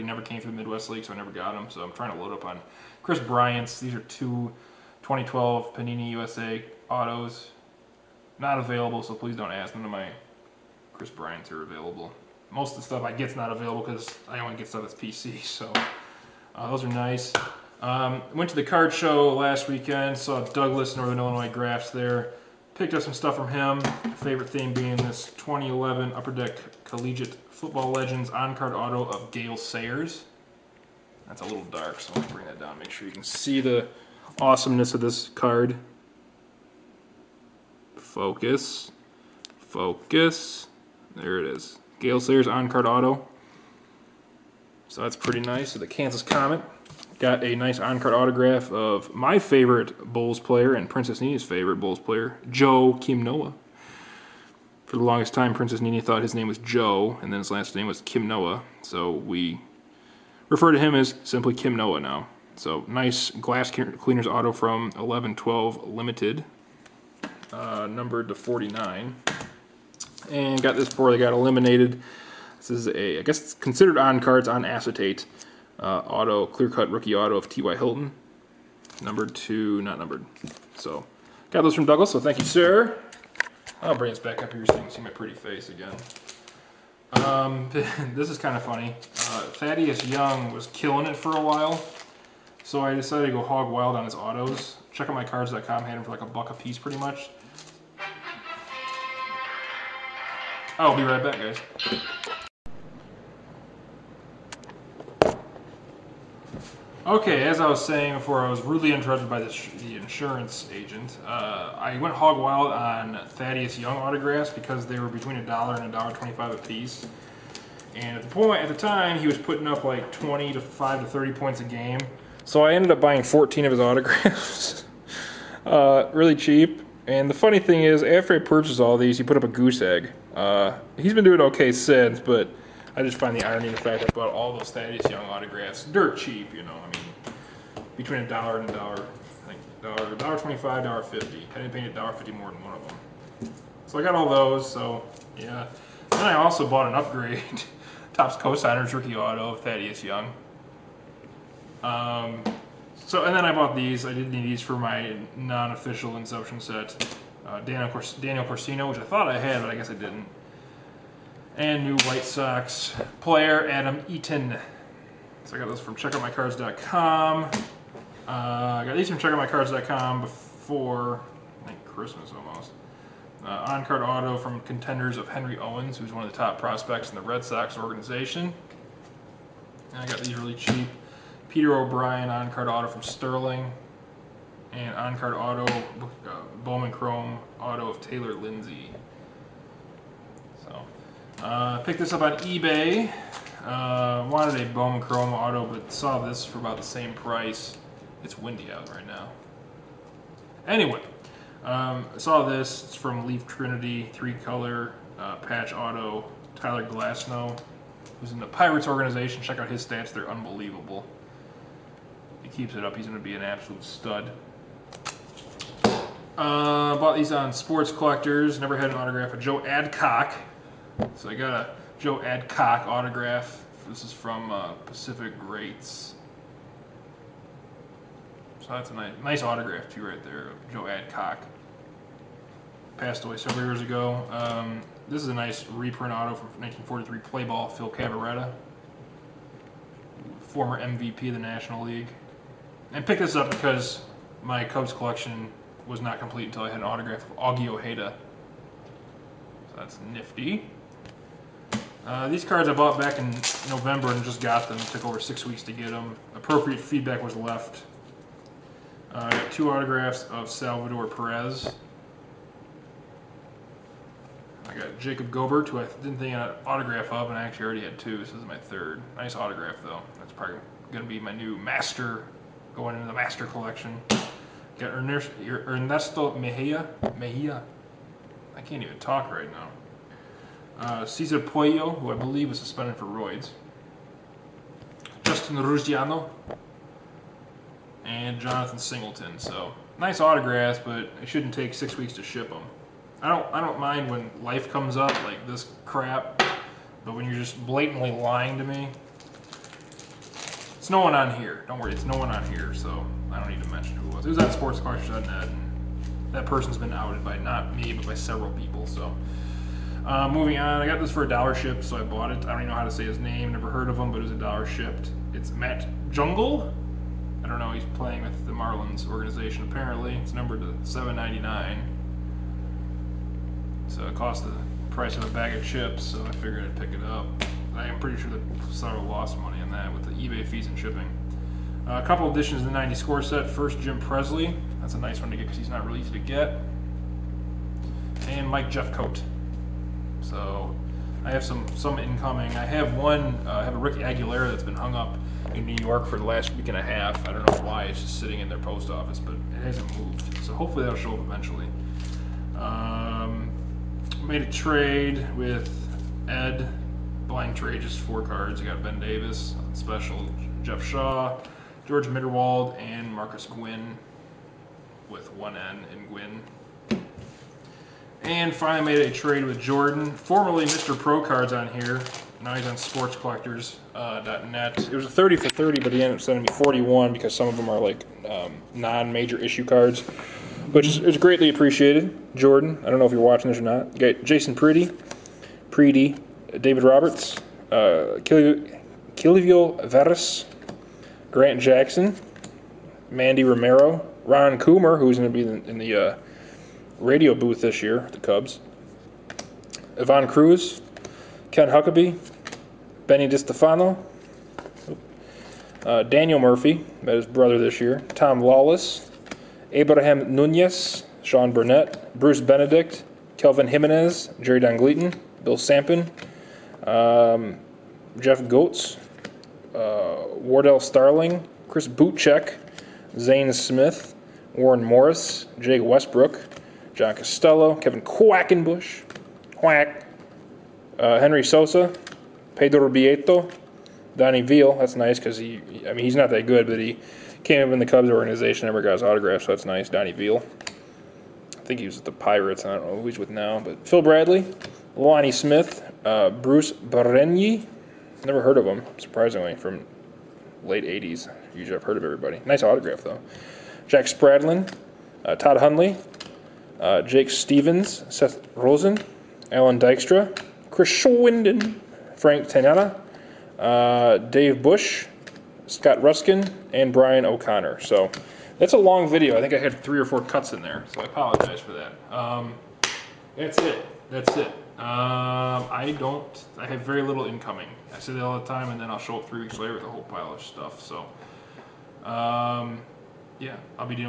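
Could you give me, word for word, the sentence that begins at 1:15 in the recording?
Uh, auto, clear cut rookie auto of T.Y.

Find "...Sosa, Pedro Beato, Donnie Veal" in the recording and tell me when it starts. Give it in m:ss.
7:11.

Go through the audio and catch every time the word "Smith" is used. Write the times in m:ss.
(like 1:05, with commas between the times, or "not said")
7:03, 7:25.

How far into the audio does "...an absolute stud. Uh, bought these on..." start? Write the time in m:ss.
3:33.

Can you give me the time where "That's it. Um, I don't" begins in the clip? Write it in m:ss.
7:54.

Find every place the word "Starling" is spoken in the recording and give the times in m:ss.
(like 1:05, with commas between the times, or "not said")
7:00.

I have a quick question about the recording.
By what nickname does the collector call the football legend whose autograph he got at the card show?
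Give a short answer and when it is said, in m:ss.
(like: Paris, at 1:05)
Kansas Comet, at 0:45.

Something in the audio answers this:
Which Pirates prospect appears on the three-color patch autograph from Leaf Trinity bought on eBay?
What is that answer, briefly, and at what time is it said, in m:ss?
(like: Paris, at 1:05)
Tyler Glasnow, at 3:26.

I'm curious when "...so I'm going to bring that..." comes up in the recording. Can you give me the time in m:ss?
0:32.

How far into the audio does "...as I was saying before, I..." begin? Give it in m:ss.
1:47.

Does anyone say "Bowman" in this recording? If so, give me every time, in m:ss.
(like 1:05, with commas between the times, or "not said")
3:06, 3:14.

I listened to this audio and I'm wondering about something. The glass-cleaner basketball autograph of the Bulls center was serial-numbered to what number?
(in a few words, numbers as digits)
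49.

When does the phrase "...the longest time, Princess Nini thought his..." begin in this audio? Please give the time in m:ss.
0:54.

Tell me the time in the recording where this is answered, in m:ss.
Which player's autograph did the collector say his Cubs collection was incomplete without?
4:07.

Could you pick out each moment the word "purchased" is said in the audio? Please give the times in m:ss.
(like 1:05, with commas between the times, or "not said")
2:08.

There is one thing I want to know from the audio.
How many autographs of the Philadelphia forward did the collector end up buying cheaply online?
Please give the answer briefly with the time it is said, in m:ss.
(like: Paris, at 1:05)
14, at 2:03.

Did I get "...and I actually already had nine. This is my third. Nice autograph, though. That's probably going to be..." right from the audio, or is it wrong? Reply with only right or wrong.
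wrong.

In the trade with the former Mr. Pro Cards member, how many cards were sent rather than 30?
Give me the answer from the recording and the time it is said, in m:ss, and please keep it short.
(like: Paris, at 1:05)
41, at 6:16.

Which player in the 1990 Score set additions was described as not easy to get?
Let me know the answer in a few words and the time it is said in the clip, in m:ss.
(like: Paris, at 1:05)
Jim Presley, at 5:33.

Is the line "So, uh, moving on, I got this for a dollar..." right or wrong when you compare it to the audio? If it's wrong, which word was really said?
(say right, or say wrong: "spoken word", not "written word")
right.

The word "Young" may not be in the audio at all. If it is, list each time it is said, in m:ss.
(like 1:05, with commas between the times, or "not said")
1:30, 1:53, 2:15, 2:30.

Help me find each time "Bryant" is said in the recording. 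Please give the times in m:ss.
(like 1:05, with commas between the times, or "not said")
0:03, 0:11.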